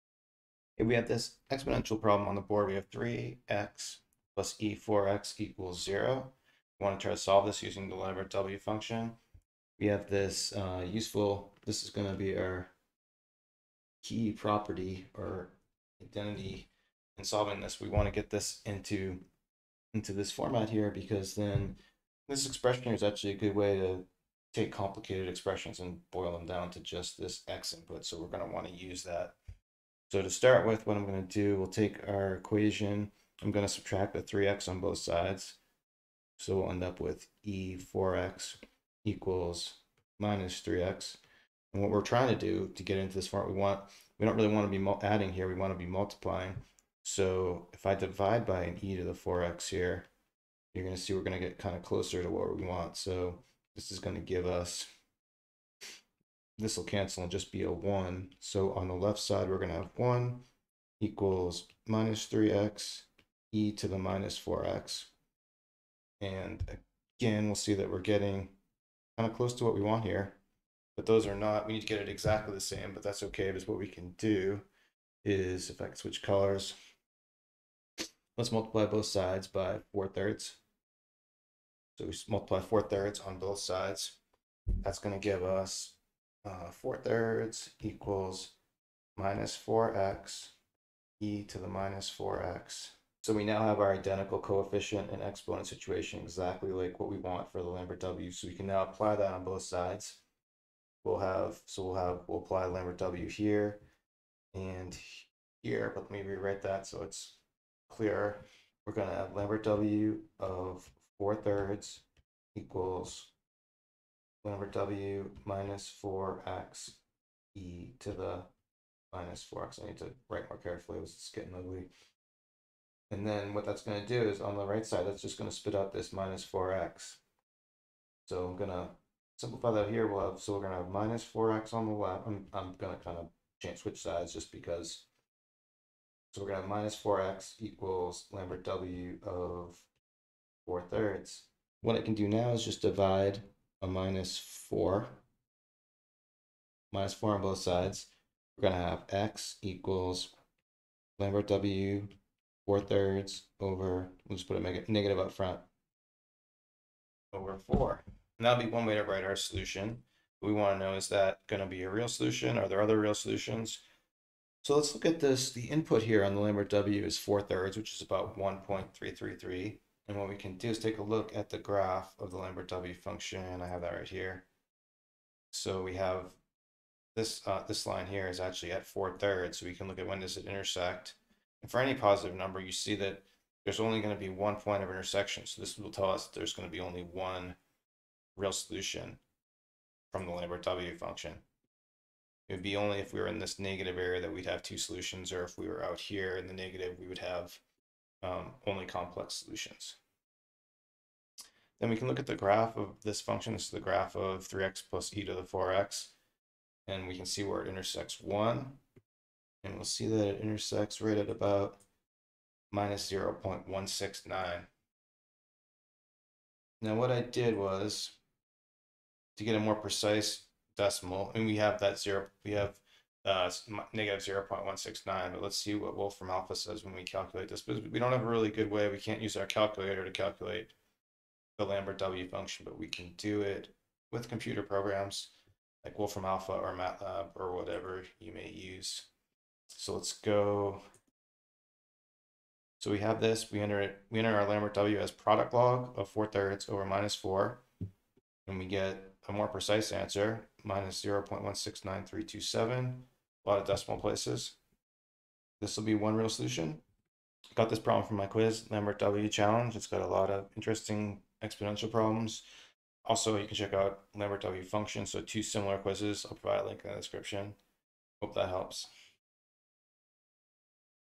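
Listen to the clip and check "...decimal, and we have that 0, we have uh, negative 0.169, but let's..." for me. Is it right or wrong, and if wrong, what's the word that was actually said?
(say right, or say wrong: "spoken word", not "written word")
right.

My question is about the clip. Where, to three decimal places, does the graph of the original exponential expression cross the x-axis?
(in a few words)
-0.169.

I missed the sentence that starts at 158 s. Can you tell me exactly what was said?
And that'll be one way to write our solution.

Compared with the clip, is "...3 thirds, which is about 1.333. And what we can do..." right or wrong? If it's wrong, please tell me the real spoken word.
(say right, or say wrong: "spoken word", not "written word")
wrong: "4", not "3".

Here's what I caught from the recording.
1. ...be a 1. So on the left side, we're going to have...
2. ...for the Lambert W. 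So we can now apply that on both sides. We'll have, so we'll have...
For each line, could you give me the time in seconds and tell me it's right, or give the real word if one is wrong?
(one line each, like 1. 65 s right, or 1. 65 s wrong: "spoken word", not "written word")
1. 57 s right
2. 97 s right.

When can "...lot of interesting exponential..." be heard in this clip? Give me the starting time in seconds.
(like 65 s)
260 s.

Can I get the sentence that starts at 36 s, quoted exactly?
So we'll end up with e4x equals minus 3x.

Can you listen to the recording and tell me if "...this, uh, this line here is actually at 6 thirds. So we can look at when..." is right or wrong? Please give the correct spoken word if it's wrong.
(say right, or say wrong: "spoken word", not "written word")
wrong: "4", not "6".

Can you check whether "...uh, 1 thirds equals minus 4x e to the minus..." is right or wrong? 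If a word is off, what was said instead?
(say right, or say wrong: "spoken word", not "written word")
wrong: "4", not "1".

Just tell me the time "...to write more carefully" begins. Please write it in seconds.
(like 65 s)
119 s.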